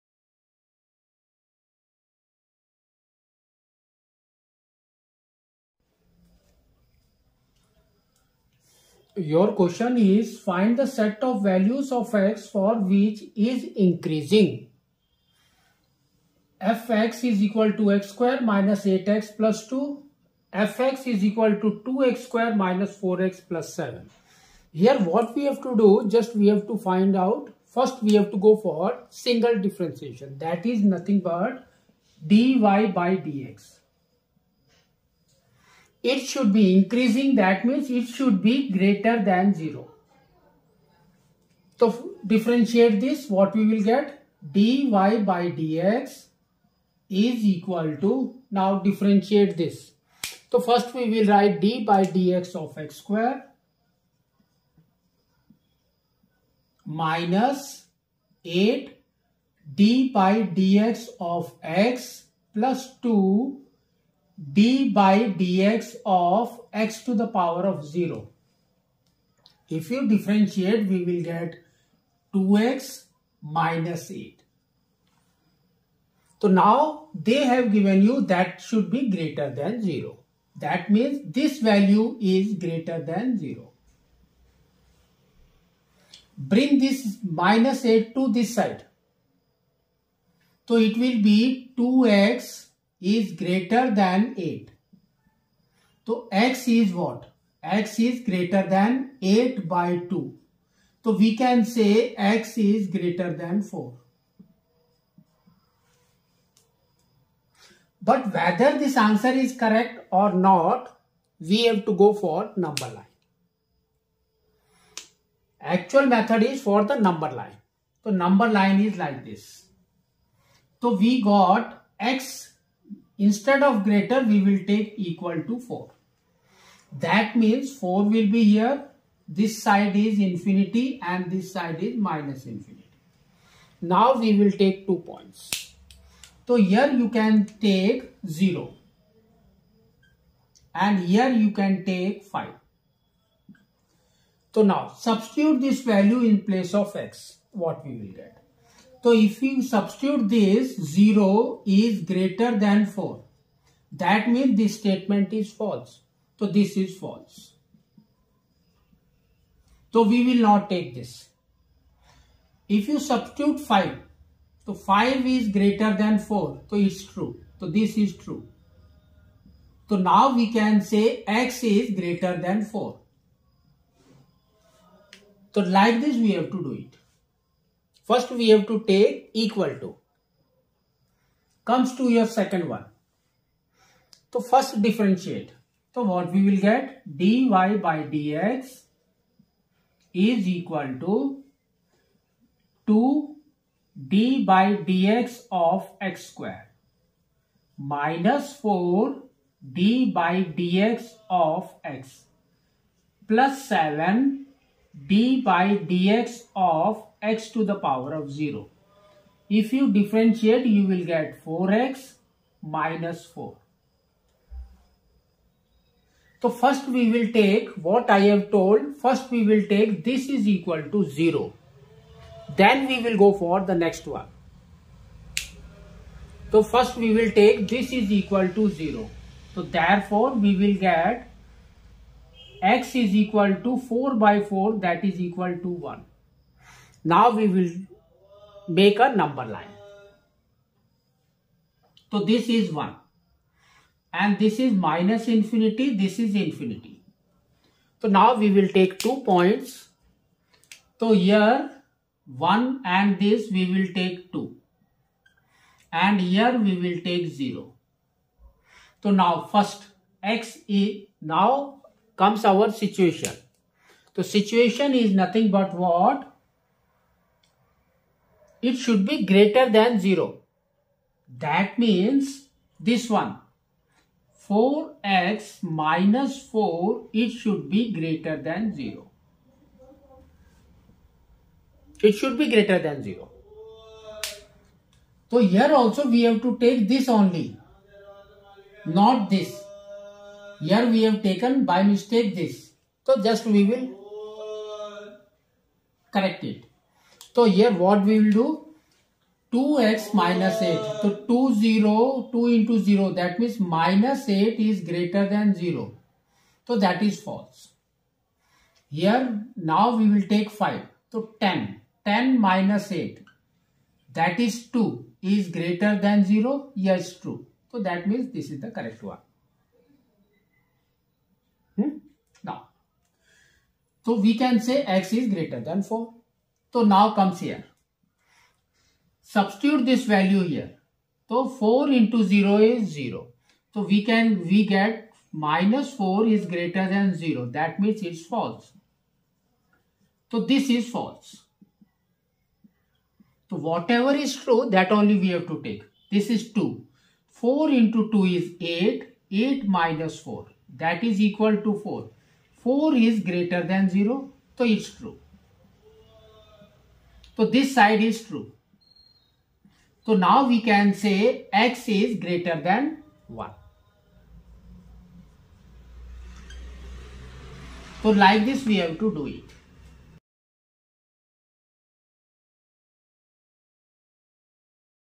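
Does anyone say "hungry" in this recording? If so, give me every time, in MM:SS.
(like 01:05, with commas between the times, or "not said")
not said.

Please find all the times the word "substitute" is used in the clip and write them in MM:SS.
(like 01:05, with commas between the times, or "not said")
02:24, 02:29, 02:42, 05:29.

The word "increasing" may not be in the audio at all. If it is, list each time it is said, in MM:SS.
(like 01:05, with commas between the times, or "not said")
00:13, 00:36.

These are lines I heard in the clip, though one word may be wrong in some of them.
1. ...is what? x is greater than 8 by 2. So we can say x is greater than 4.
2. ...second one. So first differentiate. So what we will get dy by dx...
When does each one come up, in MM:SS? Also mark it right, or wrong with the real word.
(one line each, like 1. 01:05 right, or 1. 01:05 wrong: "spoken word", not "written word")
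1. 01:36 right
2. 03:02 right.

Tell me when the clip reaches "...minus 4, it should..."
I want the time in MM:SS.
04:35.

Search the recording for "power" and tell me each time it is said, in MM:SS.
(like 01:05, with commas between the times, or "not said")
01:07, 03:27.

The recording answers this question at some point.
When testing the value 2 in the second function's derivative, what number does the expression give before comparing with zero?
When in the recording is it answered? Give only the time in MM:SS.
05:50.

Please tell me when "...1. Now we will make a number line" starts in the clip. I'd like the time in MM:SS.
03:55.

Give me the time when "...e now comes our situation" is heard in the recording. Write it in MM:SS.
04:20.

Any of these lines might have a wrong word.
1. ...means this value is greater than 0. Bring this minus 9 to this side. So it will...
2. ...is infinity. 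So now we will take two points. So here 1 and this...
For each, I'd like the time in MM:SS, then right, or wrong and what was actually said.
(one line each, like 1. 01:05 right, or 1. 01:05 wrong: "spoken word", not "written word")
1. 01:20 wrong: "8", not "9"
2. 04:06 right.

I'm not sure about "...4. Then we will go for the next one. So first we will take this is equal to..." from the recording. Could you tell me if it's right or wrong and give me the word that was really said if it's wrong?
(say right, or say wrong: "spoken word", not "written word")
wrong: "0", not "4".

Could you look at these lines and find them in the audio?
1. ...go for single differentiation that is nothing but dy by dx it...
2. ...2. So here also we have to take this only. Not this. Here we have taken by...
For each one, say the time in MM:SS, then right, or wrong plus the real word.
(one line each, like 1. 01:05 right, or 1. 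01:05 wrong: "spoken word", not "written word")
1. 00:28 right
2. 04:43 wrong: "0", not "2".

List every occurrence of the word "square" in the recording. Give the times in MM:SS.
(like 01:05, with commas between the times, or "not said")
00:18, 00:22, 00:52, 03:16.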